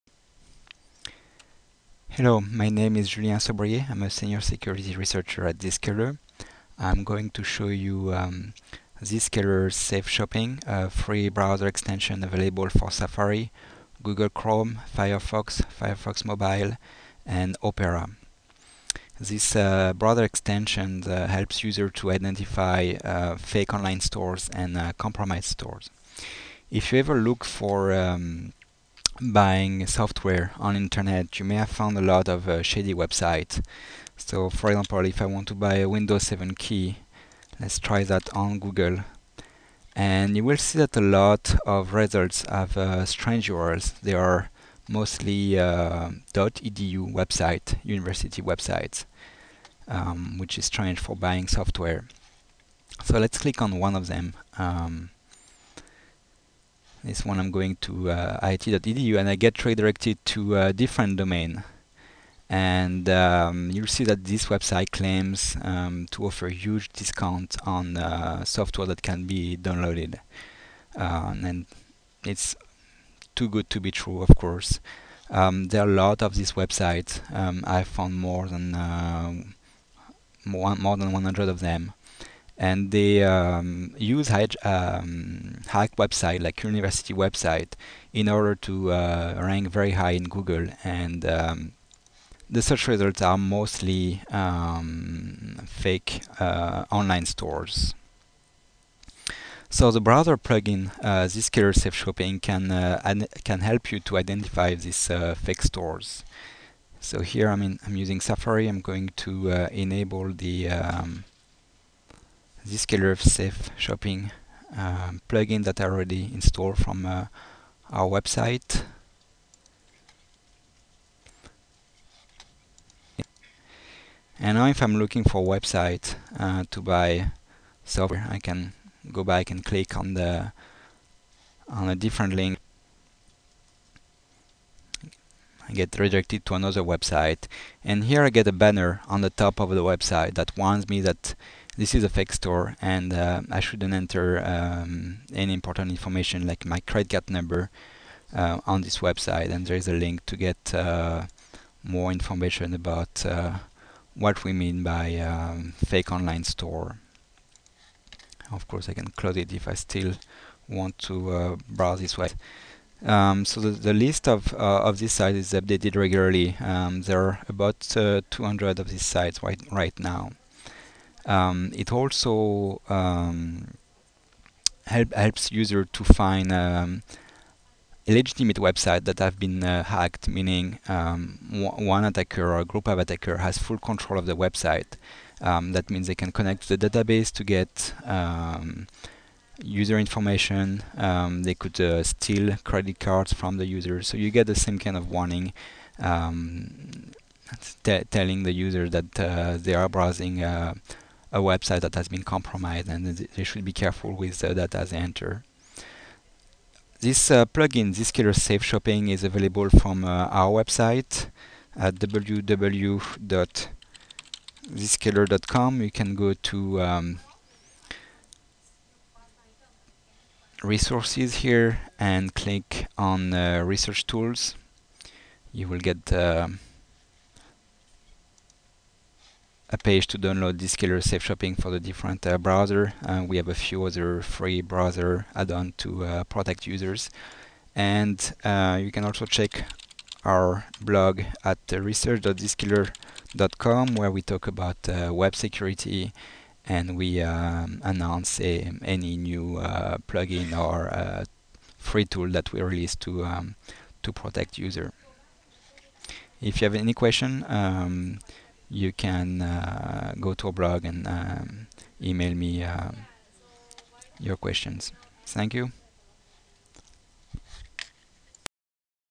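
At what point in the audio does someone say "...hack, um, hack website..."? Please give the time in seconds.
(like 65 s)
84 s.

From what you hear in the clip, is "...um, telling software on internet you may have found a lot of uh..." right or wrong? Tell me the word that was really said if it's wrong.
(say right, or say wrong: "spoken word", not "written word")
wrong: "buying", not "telling".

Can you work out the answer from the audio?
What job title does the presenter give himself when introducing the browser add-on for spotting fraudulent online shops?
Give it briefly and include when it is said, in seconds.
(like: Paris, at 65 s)
senior security researcher, at 4 s.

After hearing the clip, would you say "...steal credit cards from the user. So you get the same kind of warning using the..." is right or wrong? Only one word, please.
wrong.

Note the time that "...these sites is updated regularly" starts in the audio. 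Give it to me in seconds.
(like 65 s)
164 s.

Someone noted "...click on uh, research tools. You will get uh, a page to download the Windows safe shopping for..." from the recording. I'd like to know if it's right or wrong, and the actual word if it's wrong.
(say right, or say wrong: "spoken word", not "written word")
wrong: "Zscaler", not "Windows".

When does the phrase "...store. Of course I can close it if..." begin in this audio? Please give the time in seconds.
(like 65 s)
156 s.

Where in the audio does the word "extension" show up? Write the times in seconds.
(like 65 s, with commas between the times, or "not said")
11 s, 20 s.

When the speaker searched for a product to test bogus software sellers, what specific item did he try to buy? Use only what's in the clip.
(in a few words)
Windows 7 key.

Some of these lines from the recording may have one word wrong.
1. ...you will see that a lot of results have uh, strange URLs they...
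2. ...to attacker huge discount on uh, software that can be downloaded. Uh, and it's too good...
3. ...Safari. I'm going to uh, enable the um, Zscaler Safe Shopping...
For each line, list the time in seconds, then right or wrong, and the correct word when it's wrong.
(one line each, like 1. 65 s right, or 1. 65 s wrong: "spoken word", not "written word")
1. 40 s right
2. 66 s wrong: "offer", not "attacker"
3. 108 s right.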